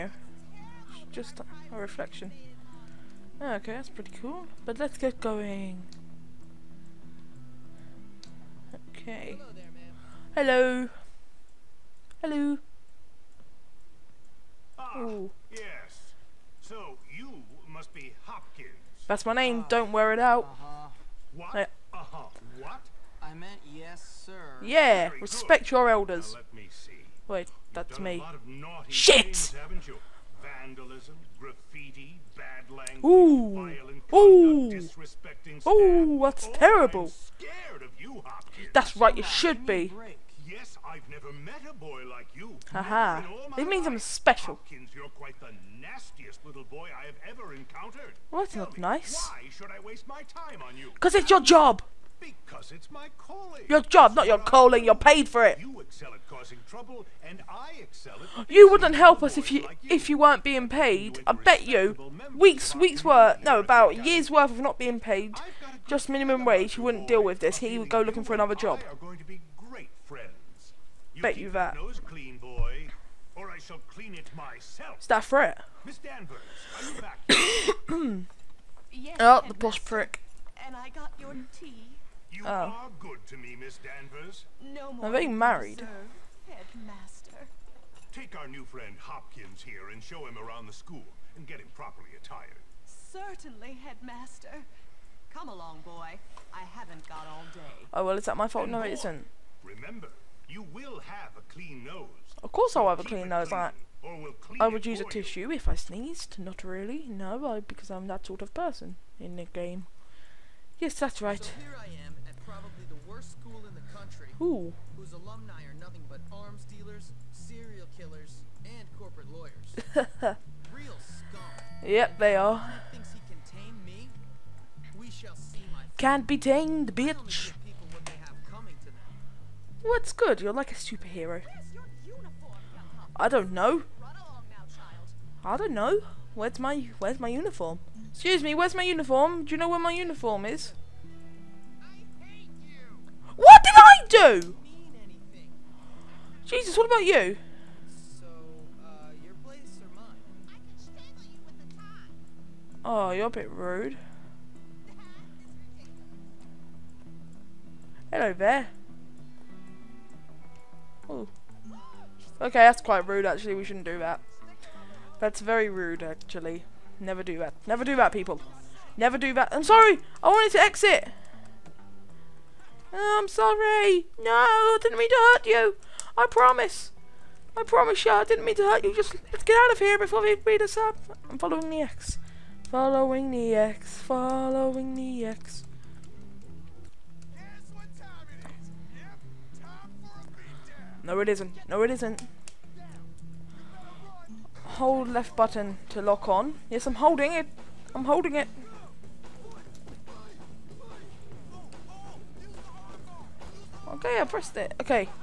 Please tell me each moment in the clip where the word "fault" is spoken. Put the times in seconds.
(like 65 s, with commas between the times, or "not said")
98 s.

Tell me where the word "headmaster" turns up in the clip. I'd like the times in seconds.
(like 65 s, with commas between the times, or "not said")
86 s, 93 s.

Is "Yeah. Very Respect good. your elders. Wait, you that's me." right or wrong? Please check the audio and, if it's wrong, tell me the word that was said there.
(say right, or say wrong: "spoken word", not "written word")
right.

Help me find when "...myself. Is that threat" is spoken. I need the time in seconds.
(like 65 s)
74 s.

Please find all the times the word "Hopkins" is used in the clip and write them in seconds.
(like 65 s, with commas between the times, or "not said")
18 s, 44 s, 88 s.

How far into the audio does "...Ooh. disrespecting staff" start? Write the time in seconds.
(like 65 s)
34 s.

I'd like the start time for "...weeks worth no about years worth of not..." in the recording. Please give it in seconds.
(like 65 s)
62 s.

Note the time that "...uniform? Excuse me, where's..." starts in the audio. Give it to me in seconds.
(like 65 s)
137 s.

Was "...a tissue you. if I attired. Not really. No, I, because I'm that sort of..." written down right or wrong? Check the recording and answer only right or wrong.
wrong.